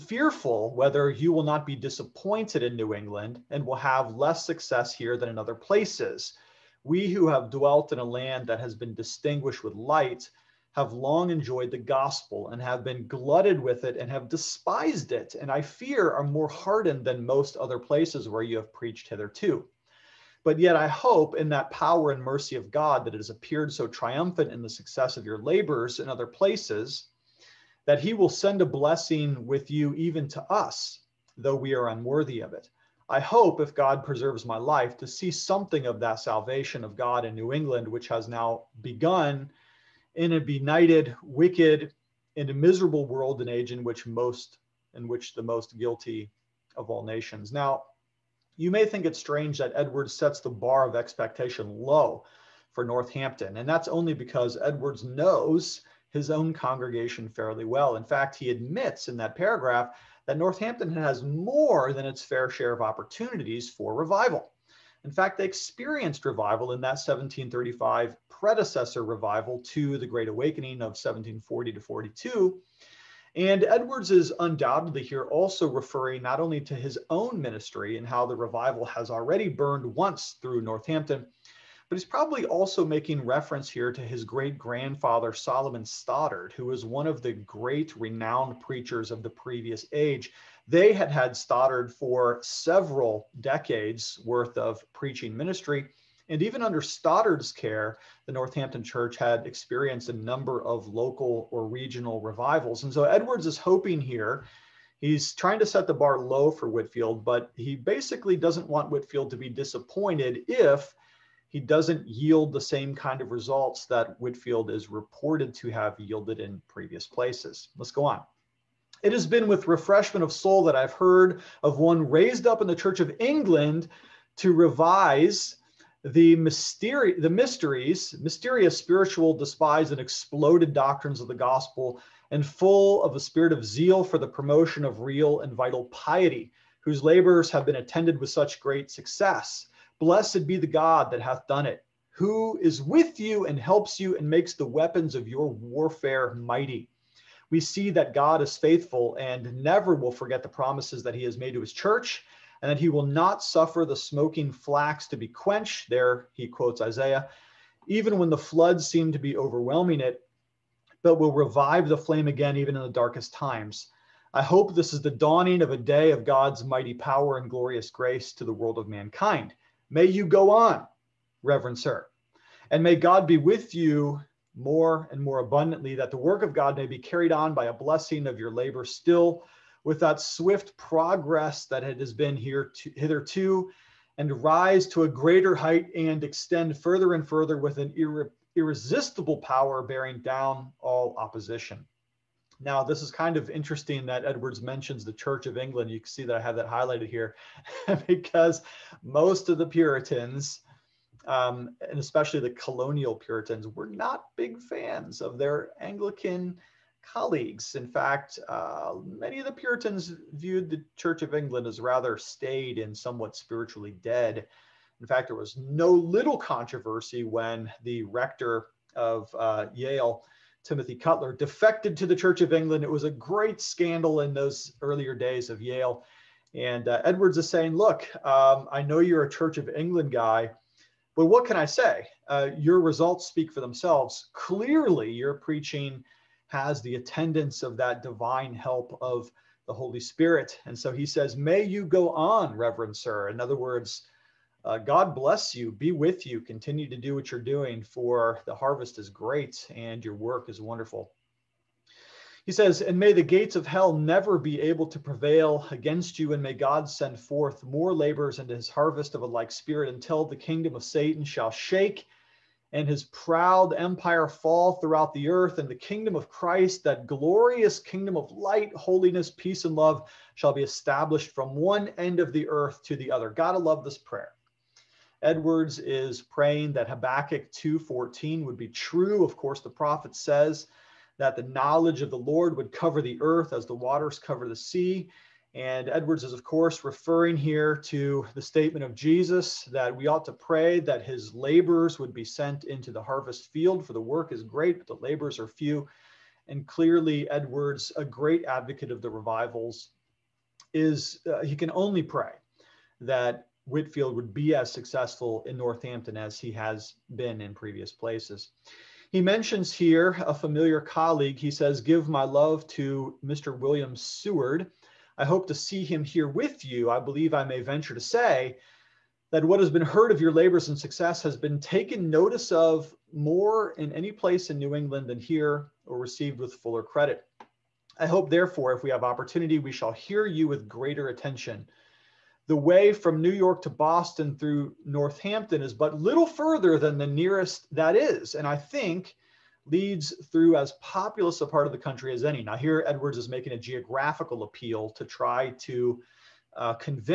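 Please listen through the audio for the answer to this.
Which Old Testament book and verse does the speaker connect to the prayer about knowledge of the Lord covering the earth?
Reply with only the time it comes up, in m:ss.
4:36.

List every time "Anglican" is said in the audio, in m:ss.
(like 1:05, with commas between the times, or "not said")
3:25.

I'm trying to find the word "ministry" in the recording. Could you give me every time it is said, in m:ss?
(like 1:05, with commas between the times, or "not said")
1:17, 1:35.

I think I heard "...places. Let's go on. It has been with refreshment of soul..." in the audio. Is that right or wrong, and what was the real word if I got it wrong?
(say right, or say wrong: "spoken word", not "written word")
right.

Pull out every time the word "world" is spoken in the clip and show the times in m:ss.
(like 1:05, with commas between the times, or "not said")
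0:43, 2:48.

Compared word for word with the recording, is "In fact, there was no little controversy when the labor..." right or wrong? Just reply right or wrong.
wrong.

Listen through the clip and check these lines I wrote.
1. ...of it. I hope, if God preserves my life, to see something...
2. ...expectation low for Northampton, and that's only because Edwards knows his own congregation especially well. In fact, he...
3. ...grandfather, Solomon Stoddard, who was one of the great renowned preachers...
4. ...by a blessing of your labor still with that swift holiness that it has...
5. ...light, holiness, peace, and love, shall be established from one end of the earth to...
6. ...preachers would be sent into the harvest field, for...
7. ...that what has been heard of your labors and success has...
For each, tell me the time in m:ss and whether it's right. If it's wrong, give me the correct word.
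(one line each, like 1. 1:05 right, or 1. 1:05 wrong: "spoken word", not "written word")
1. 0:32 right
2. 0:50 wrong: "fairly", not "especially"
3. 1:24 right
4. 2:57 wrong: "progress", not "holiness"
5. 4:28 right
6. 4:51 wrong: "laborers", not "preachers"
7. 5:19 right.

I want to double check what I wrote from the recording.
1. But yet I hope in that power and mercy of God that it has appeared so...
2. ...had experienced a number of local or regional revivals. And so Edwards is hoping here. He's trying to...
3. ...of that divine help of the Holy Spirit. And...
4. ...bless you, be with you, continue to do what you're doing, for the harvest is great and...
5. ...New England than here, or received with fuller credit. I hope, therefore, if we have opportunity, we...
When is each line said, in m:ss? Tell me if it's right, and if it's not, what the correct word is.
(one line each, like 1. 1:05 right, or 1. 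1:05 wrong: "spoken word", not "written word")
1. 0:20 right
2. 1:39 right
3. 3:57 right
4. 4:05 right
5. 5:24 right.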